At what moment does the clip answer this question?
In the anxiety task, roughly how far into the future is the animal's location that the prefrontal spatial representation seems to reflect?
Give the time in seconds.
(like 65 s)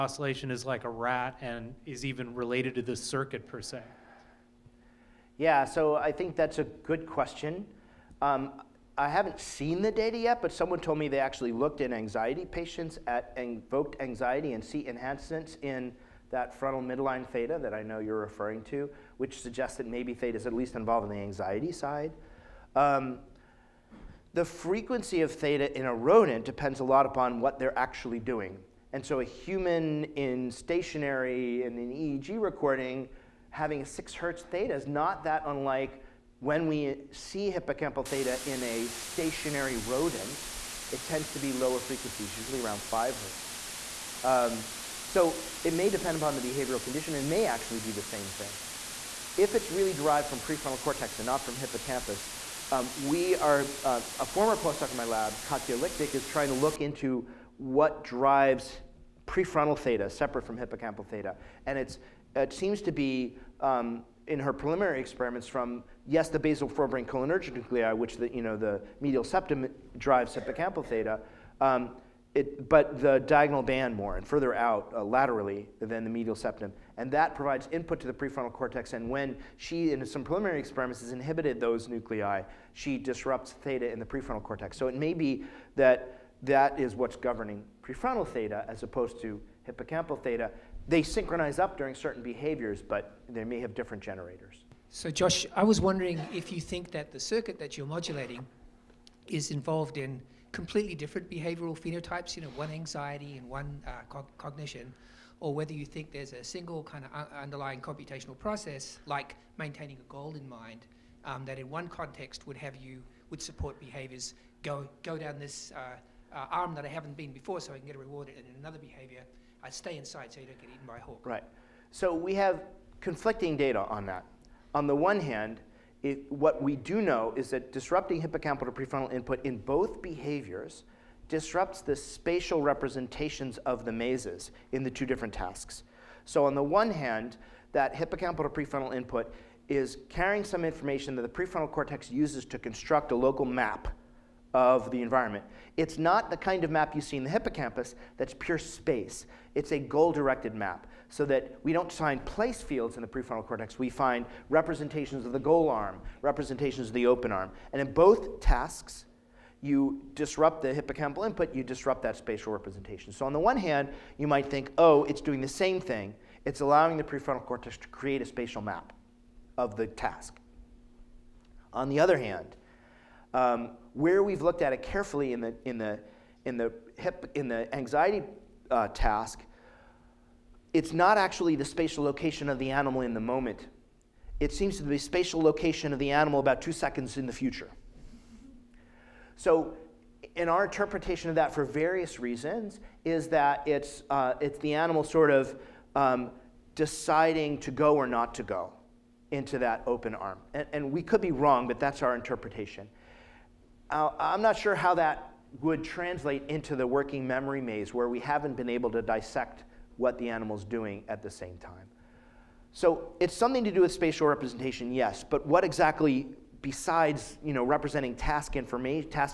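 186 s.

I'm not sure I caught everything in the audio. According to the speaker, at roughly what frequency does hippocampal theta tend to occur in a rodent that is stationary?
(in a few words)
5 hertz.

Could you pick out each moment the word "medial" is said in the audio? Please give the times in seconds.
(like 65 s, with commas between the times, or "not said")
69 s, 76 s.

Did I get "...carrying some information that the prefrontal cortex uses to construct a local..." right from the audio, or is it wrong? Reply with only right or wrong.
right.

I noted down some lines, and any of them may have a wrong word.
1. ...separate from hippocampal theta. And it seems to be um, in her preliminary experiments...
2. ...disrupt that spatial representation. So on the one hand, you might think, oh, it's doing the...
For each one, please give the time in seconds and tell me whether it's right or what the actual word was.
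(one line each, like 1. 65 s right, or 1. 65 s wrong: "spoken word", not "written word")
1. 60 s right
2. 161 s right.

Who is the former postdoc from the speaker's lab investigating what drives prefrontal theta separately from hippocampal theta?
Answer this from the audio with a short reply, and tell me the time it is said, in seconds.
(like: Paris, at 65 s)
Katya Lichtig, at 55 s.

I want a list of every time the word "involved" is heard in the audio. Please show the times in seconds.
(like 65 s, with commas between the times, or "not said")
20 s, 99 s.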